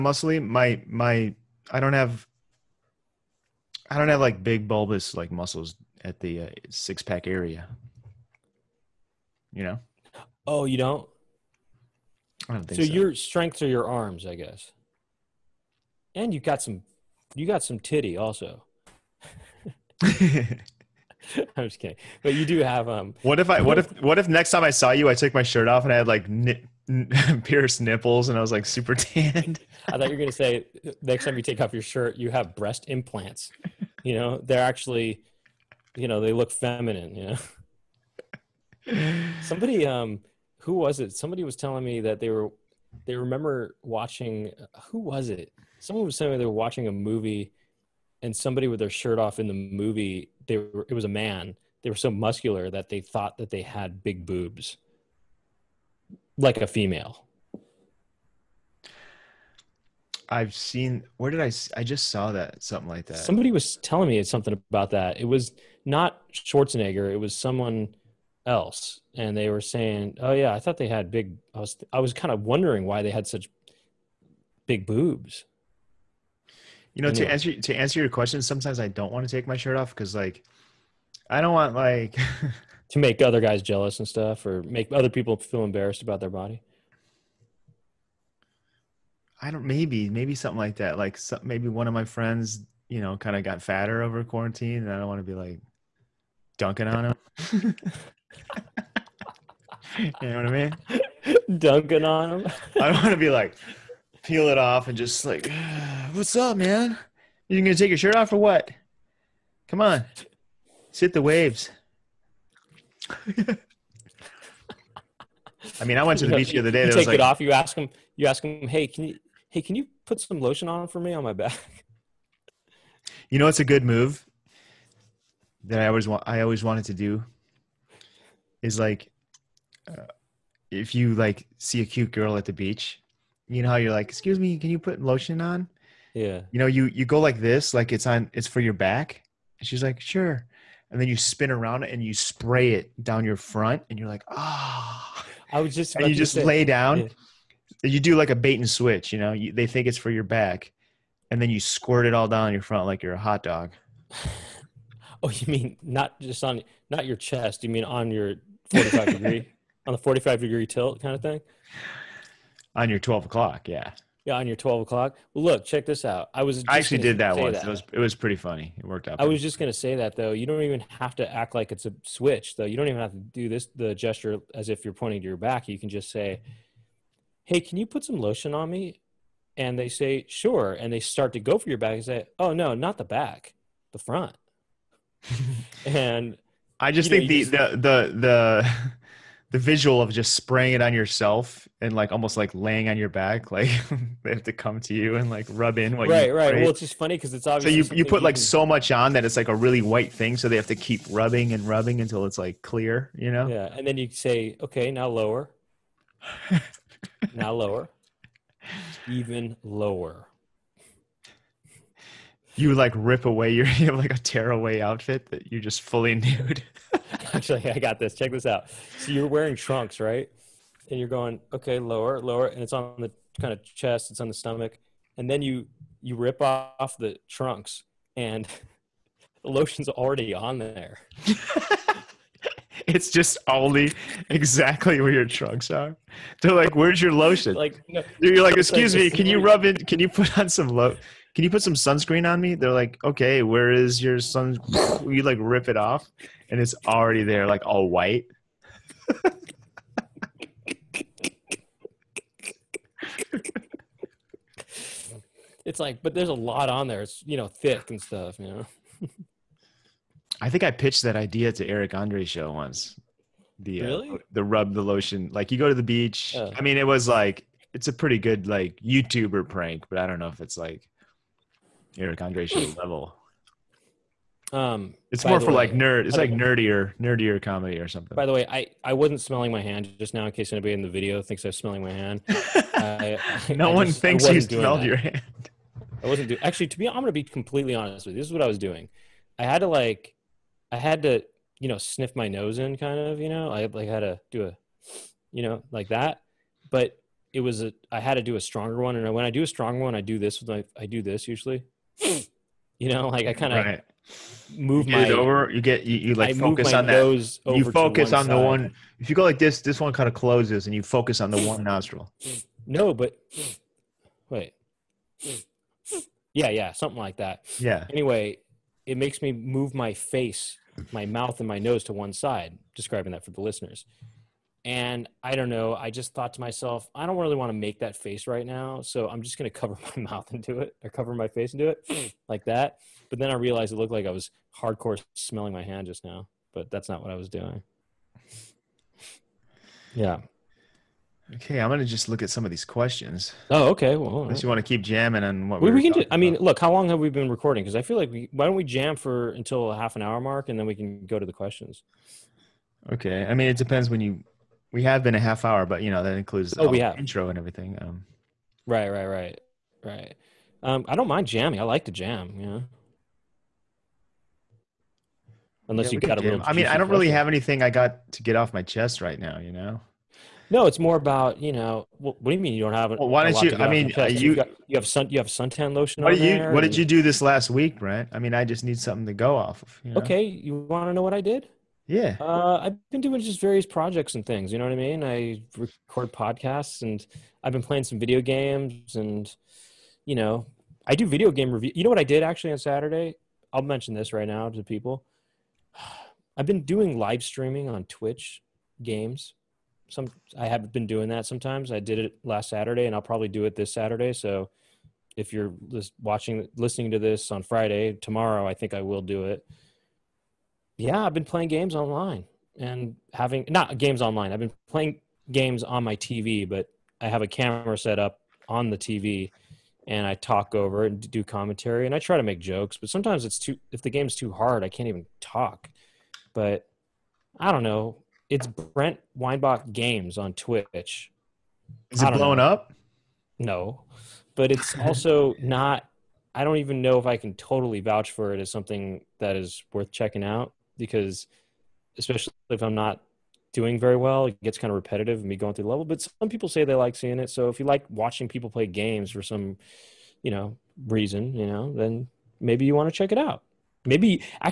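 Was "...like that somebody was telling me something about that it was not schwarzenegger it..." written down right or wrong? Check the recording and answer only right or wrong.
right.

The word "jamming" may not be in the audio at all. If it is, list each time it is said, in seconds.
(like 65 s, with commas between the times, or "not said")
344 s, 361 s.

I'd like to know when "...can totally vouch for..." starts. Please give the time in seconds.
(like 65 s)
437 s.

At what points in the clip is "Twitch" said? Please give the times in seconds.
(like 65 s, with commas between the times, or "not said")
397 s, 430 s.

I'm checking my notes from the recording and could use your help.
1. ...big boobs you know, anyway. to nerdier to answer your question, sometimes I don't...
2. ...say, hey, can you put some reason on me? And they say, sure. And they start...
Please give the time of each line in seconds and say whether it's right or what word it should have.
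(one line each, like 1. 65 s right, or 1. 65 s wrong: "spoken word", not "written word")
1. 74 s wrong: "answer", not "nerdier"
2. 176 s wrong: "lotion", not "reason".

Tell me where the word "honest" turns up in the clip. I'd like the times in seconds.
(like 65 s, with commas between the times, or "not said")
287 s.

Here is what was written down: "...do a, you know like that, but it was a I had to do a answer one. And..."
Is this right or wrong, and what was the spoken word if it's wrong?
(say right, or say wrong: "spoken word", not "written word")
wrong: "stronger", not "answer".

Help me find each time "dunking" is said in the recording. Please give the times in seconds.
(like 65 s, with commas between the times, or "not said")
96 s, 101 s.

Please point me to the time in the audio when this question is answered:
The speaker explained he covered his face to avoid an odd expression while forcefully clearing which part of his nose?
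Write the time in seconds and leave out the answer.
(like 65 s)
311 s.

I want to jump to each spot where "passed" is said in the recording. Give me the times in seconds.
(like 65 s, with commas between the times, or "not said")
not said.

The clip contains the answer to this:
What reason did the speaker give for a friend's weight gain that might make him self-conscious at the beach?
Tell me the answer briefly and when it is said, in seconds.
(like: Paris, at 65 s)
Quarantine, at 94 s.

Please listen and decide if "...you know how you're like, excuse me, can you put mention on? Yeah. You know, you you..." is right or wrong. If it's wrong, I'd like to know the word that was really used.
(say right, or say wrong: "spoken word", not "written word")
wrong: "lotion", not "mention".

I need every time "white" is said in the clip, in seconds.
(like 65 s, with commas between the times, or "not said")
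199 s, 247 s.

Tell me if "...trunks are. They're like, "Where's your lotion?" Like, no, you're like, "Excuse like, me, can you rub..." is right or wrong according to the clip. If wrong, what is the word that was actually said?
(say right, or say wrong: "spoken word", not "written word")
right.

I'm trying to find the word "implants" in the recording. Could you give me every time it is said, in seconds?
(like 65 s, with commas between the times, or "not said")
32 s.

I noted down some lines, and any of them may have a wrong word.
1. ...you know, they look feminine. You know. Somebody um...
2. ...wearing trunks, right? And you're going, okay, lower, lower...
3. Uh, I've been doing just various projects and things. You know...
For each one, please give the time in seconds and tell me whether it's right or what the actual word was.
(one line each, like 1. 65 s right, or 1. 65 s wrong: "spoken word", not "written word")
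1. 35 s right
2. 219 s right
3. 382 s right.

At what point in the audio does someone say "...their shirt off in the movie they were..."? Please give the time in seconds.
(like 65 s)
48 s.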